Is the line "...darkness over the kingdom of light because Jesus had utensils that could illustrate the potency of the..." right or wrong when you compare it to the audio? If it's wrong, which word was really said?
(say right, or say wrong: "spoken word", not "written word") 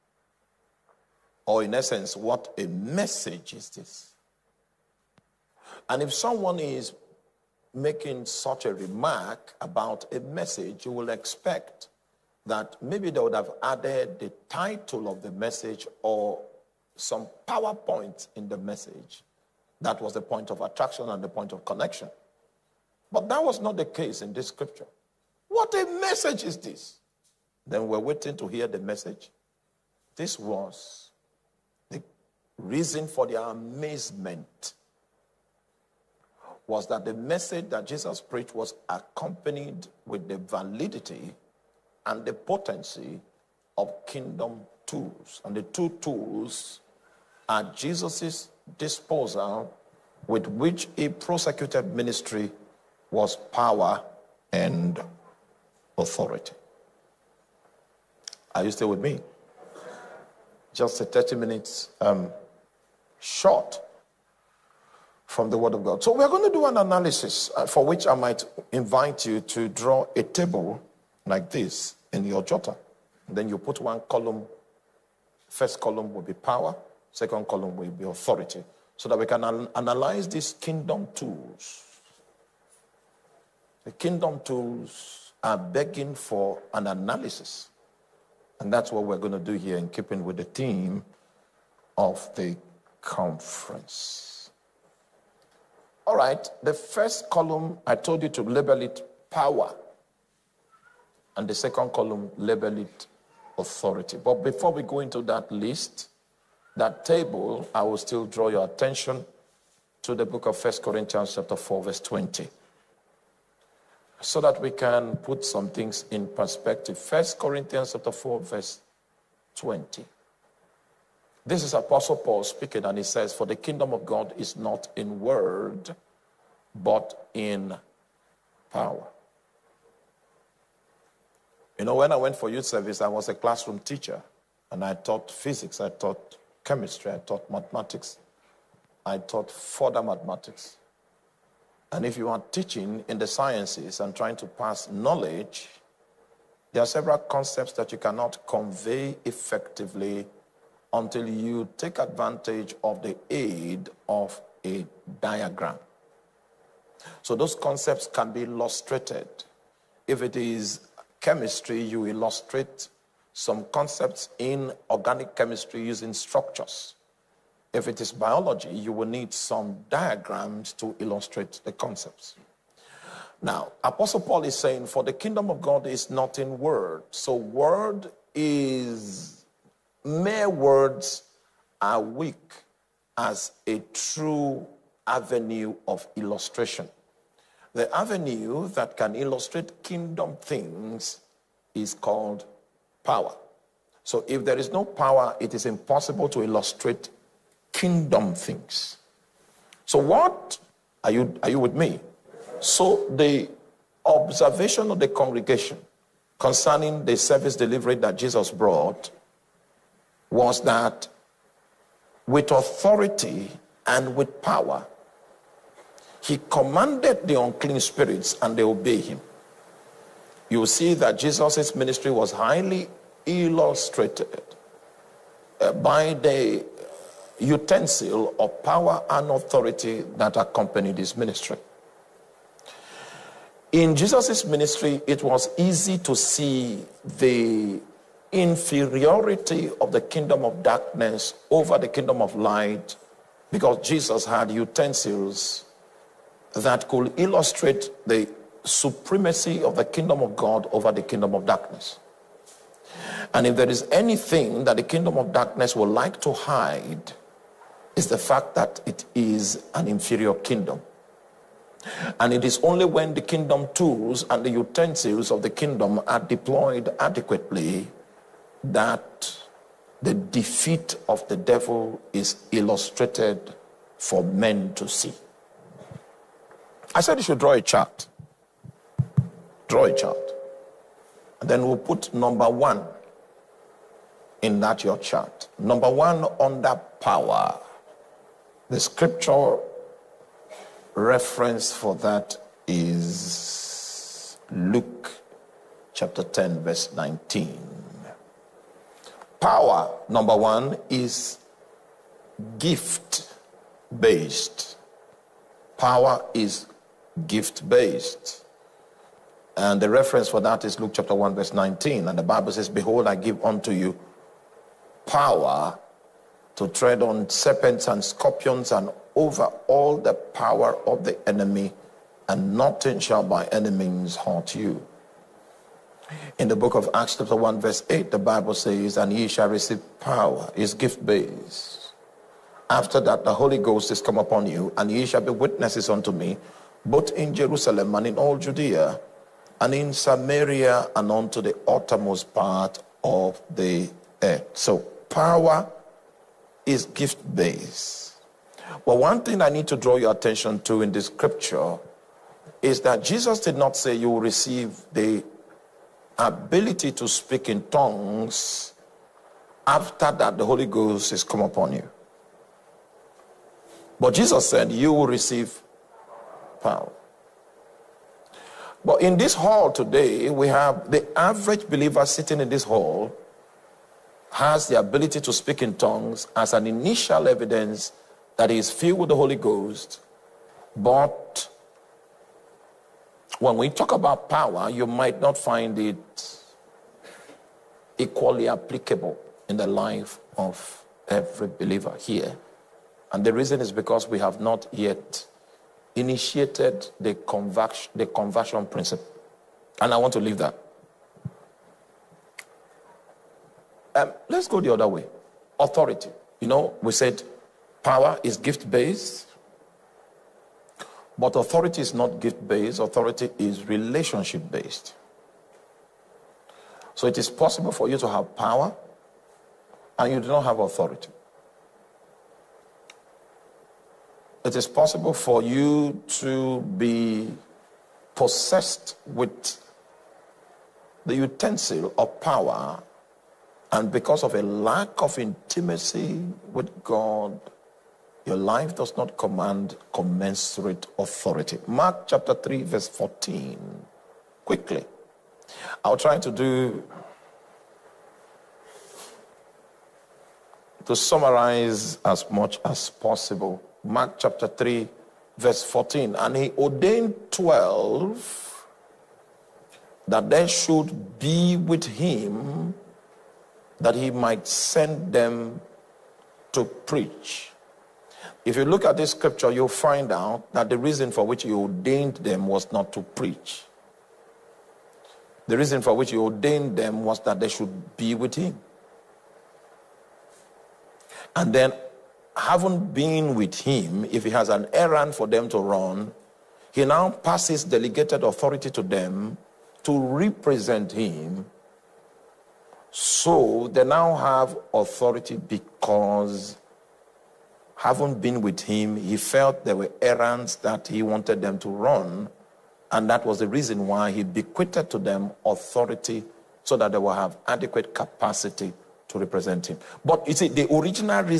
wrong: "supremacy", not "potency".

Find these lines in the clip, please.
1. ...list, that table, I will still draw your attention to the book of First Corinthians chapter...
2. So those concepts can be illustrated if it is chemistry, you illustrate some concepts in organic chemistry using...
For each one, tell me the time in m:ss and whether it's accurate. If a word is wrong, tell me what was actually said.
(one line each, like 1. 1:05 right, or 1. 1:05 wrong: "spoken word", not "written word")
1. 1:45 right
2. 2:37 right.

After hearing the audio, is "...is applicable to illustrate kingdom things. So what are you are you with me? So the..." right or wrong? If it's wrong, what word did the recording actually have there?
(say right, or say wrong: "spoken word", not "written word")
wrong: "impossible", not "applicable".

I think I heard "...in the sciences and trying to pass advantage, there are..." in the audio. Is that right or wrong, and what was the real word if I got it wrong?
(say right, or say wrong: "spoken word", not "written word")
wrong: "knowledge", not "advantage".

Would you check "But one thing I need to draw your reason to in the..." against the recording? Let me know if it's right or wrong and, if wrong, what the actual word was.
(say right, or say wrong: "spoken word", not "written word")
wrong: "attention", not "reason".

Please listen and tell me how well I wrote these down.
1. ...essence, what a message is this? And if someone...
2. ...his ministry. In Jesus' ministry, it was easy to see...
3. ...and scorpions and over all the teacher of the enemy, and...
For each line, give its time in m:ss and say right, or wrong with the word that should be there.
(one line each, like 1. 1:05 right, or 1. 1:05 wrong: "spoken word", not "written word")
1. 0:01 right
2. 3:50 right
3. 5:17 wrong: "power", not "teacher".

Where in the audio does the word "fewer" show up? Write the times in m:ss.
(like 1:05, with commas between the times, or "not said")
not said.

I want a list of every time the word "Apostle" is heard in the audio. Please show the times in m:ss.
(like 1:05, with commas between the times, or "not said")
2:01, 2:53.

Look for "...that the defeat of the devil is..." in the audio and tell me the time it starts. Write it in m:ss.
4:28.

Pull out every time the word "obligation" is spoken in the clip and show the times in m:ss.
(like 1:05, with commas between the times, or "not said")
not said.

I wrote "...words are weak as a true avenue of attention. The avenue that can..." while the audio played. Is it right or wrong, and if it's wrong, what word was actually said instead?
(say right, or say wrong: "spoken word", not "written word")
wrong: "illustration", not "attention".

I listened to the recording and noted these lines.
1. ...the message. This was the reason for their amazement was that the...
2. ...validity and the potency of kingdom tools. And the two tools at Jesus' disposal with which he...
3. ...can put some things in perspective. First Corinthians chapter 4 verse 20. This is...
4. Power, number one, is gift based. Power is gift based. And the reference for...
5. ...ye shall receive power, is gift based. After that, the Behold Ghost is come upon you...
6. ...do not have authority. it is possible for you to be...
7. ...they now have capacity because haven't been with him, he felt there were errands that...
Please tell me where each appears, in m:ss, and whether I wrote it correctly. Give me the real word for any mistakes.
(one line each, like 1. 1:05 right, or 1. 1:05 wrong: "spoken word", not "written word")
1. 0:28 right
2. 0:40 right
3. 1:54 right
4. 4:59 right
5. 5:29 wrong: "Holy", not "Behold"
6. 7:00 right
7. 8:13 wrong: "authority", not "capacity".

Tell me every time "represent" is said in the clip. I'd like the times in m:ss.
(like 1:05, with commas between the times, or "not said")
8:09, 8:29.